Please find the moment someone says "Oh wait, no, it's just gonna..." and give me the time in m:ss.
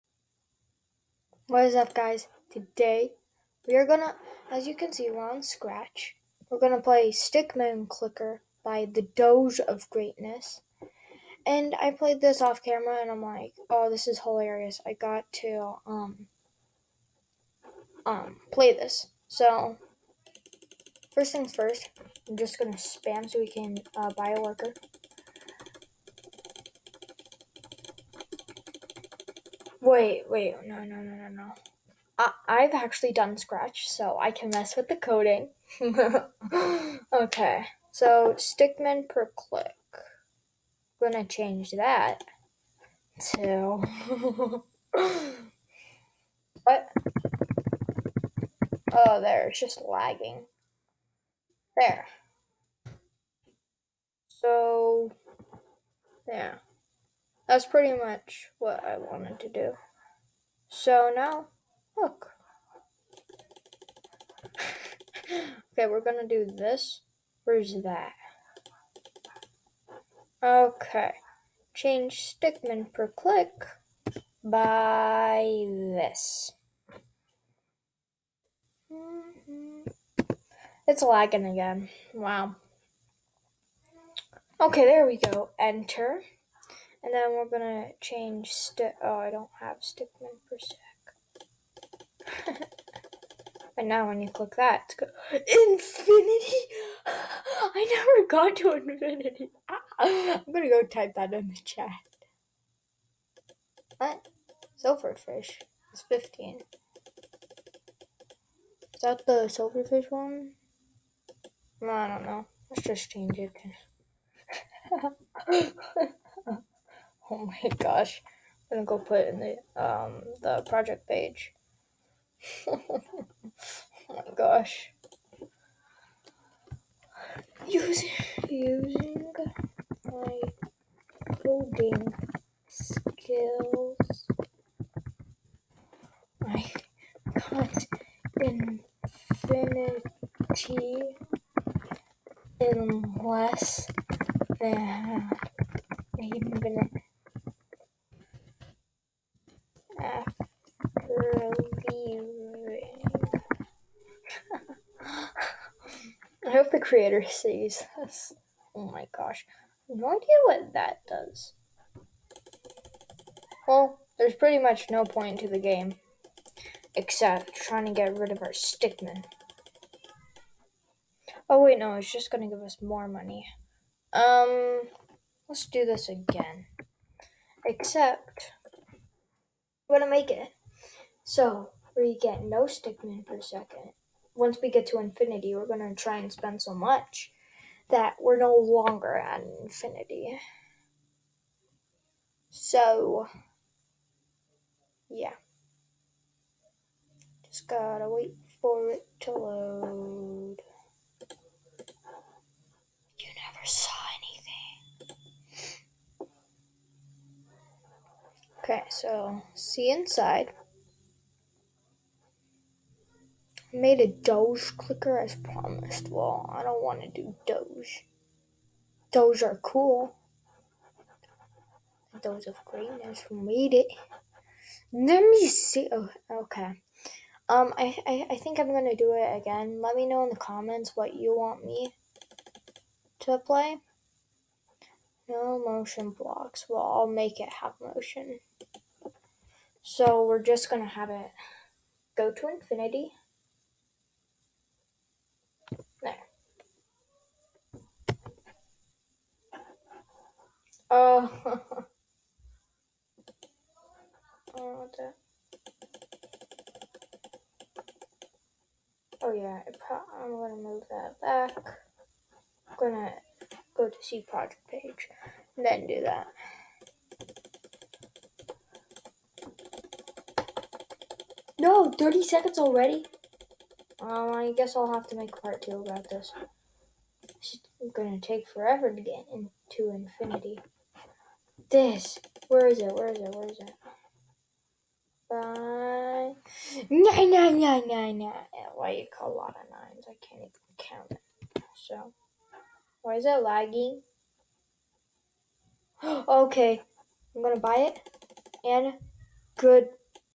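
2:51.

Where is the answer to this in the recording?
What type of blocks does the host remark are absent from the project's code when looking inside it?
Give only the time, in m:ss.
3:55.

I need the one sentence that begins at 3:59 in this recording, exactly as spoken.
So we're just gonna have it go to infinity.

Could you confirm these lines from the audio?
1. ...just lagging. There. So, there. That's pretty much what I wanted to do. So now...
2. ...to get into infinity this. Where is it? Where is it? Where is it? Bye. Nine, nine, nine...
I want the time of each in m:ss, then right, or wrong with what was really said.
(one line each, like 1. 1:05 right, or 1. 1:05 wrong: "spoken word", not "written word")
1. 0:49 right
2. 4:38 right.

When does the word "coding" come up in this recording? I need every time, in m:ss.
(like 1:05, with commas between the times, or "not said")
0:34, 2:11.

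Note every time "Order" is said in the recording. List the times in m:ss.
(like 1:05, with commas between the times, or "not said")
4:14.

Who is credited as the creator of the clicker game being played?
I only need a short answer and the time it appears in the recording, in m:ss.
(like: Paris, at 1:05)
the Doge of Greatness, at 0:08.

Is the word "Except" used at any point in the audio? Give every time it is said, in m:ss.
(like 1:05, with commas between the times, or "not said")
2:46, 2:57.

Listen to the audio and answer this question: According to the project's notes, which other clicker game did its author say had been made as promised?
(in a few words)
Doge clicker.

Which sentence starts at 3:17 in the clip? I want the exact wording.
Just gotta wait for it to load.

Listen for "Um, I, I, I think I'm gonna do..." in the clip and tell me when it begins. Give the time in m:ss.
3:47.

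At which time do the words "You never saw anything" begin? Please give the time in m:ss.
3:23.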